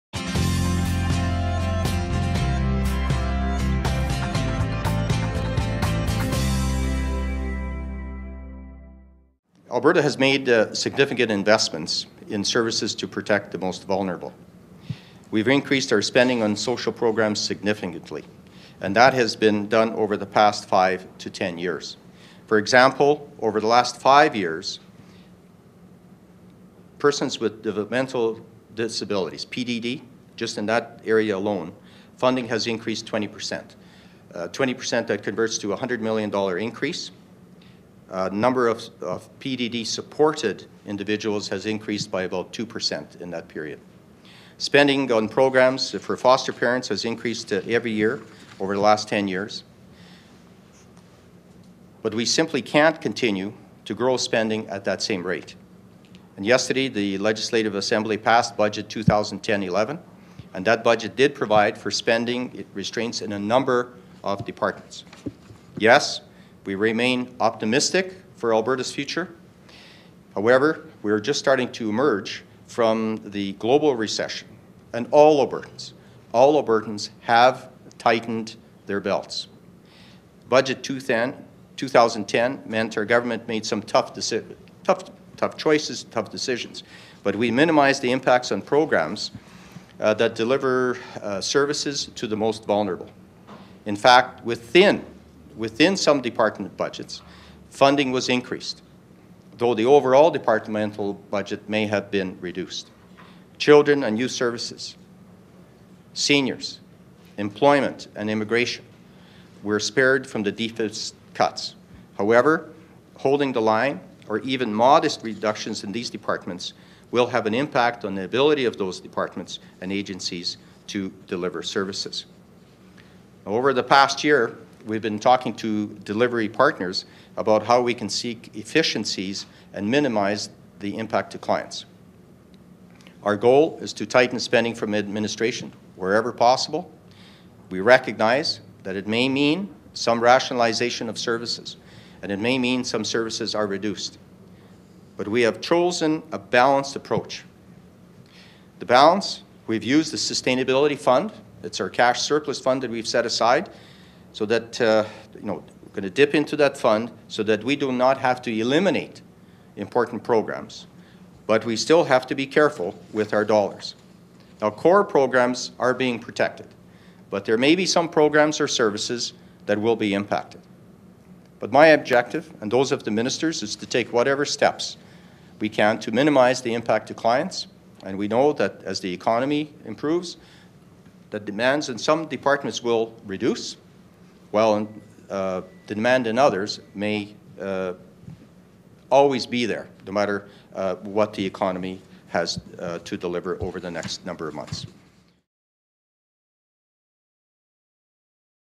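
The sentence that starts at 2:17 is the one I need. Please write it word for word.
We recognize that it may mean some rationalization of services, and it may mean some services are reduced.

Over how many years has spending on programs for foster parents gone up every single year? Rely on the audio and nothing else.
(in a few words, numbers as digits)
10 years.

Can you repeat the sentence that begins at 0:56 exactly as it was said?
And yesterday, the Legislative Assembly passed Budget 2010-11, and that budget did provide for spending restraints in a number of departments.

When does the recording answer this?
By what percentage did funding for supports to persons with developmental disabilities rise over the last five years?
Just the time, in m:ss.
0:32.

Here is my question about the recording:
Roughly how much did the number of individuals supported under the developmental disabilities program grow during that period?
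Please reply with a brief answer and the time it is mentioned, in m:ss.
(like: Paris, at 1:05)
about 2%, at 0:42.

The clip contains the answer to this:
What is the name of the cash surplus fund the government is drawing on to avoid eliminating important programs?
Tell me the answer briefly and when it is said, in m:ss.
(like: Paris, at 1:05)
Sustainability Fund, at 2:30.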